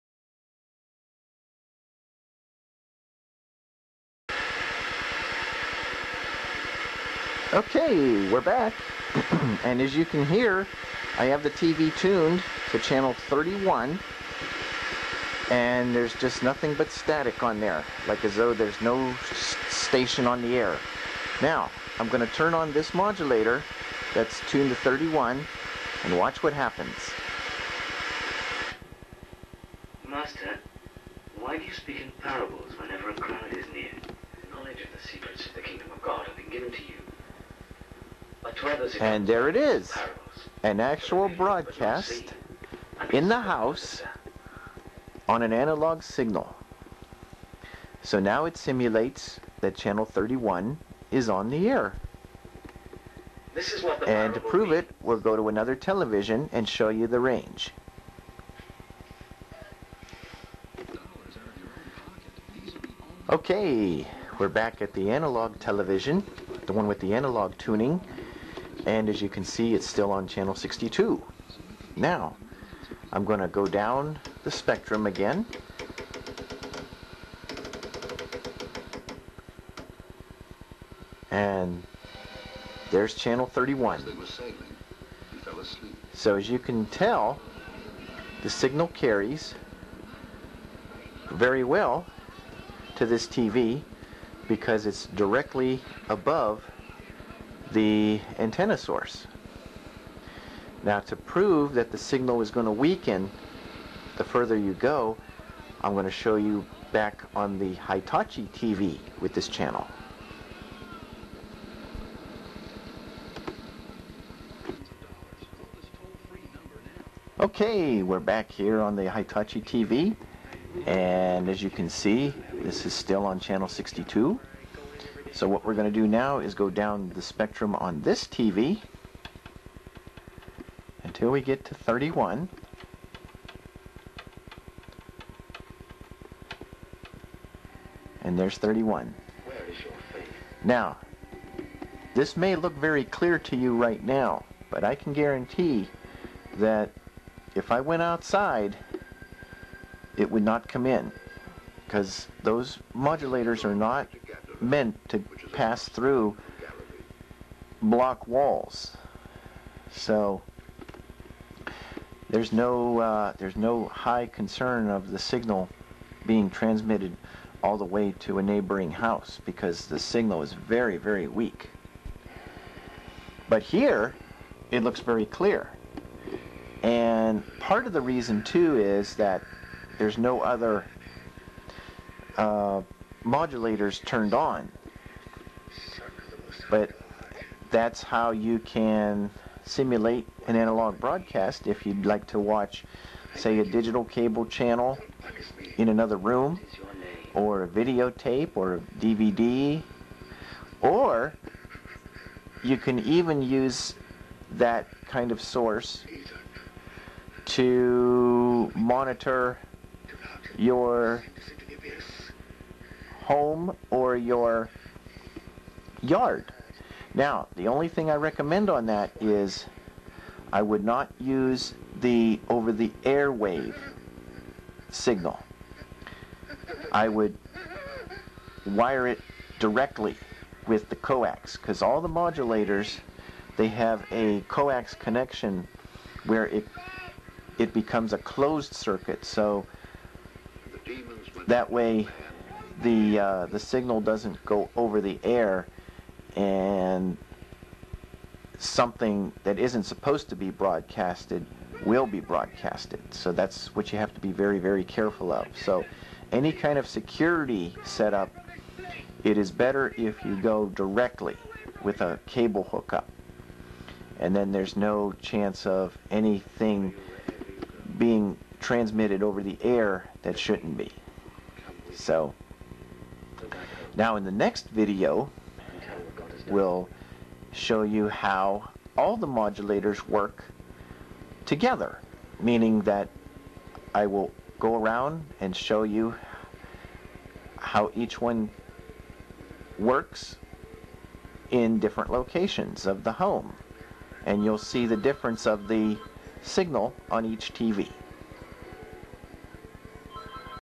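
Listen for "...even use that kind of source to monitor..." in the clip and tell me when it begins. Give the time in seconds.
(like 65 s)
202 s.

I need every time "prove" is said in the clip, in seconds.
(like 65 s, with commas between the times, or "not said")
54 s, 101 s.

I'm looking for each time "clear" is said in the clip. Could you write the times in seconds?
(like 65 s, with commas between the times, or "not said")
143 s, 175 s.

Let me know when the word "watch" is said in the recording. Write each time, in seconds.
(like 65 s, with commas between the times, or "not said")
26 s, 192 s.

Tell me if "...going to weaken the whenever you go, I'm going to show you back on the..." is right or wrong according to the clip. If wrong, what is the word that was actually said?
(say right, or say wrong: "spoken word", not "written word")
wrong: "further", not "whenever".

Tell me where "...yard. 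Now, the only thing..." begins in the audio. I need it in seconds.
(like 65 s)
216 s.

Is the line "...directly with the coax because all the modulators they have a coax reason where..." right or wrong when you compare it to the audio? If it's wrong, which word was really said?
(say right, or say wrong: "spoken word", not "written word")
wrong: "connection", not "reason".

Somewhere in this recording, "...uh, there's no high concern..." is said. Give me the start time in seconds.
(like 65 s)
162 s.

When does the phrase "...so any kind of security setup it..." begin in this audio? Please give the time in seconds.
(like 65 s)
255 s.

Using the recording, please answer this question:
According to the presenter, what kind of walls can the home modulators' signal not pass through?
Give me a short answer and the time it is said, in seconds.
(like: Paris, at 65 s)
Block walls, at 157 s.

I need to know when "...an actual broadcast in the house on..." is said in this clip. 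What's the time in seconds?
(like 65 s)
40 s.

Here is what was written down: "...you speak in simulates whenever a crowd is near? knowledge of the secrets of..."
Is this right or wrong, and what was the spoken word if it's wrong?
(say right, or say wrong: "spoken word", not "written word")
wrong: "parables", not "simulates".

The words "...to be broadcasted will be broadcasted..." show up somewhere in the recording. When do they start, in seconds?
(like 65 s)
250 s.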